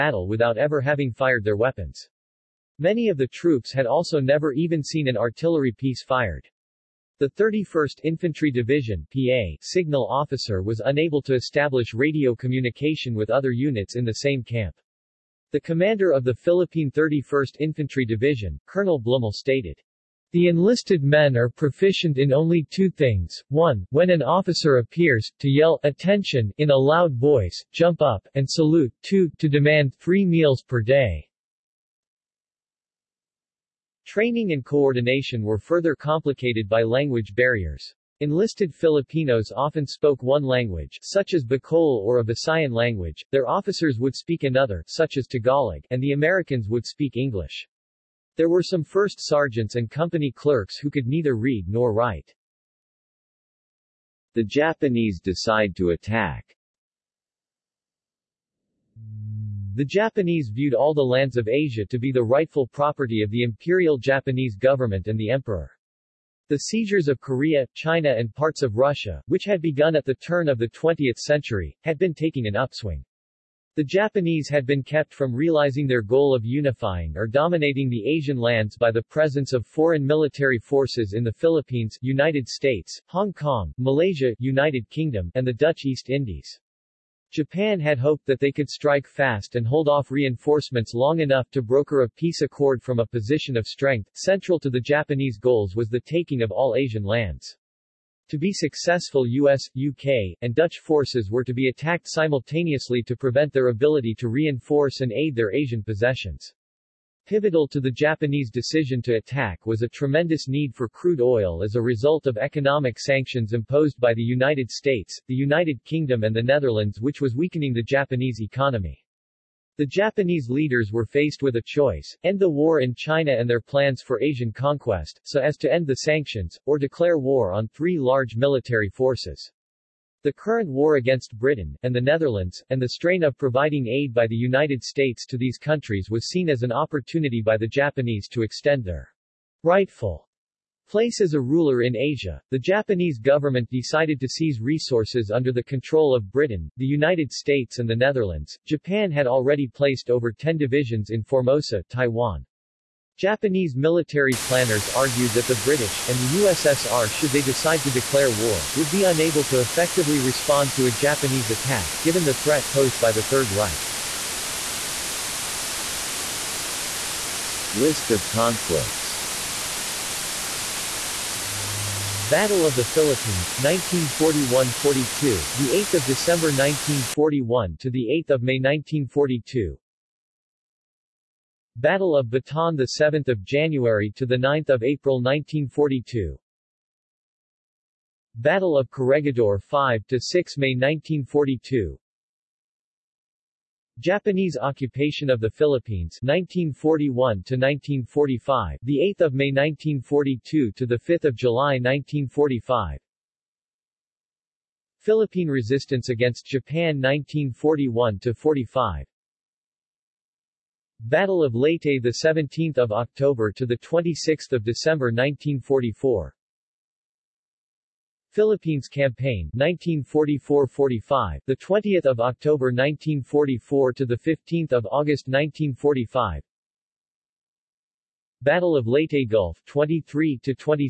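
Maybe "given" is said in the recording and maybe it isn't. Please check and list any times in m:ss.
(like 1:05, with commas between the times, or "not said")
2:42.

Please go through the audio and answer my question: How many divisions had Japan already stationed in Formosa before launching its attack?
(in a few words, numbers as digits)
over 10.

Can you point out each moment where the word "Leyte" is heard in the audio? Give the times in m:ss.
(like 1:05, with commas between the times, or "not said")
3:31, 3:48.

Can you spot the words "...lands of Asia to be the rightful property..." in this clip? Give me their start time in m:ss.
1:01.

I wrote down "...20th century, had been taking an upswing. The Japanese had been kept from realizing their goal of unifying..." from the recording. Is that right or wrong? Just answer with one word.
right.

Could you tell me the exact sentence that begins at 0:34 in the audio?
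Training and coordination were further complicated by language barriers.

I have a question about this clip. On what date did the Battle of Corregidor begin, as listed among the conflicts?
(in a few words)
5 May 1942.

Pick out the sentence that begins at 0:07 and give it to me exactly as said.
The 31st Infantry Division PA signal officer was unable to establish radio communication with other units in the same camp.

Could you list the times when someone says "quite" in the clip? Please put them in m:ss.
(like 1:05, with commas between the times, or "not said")
not said.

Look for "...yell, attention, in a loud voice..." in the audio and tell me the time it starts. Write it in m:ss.
0:25.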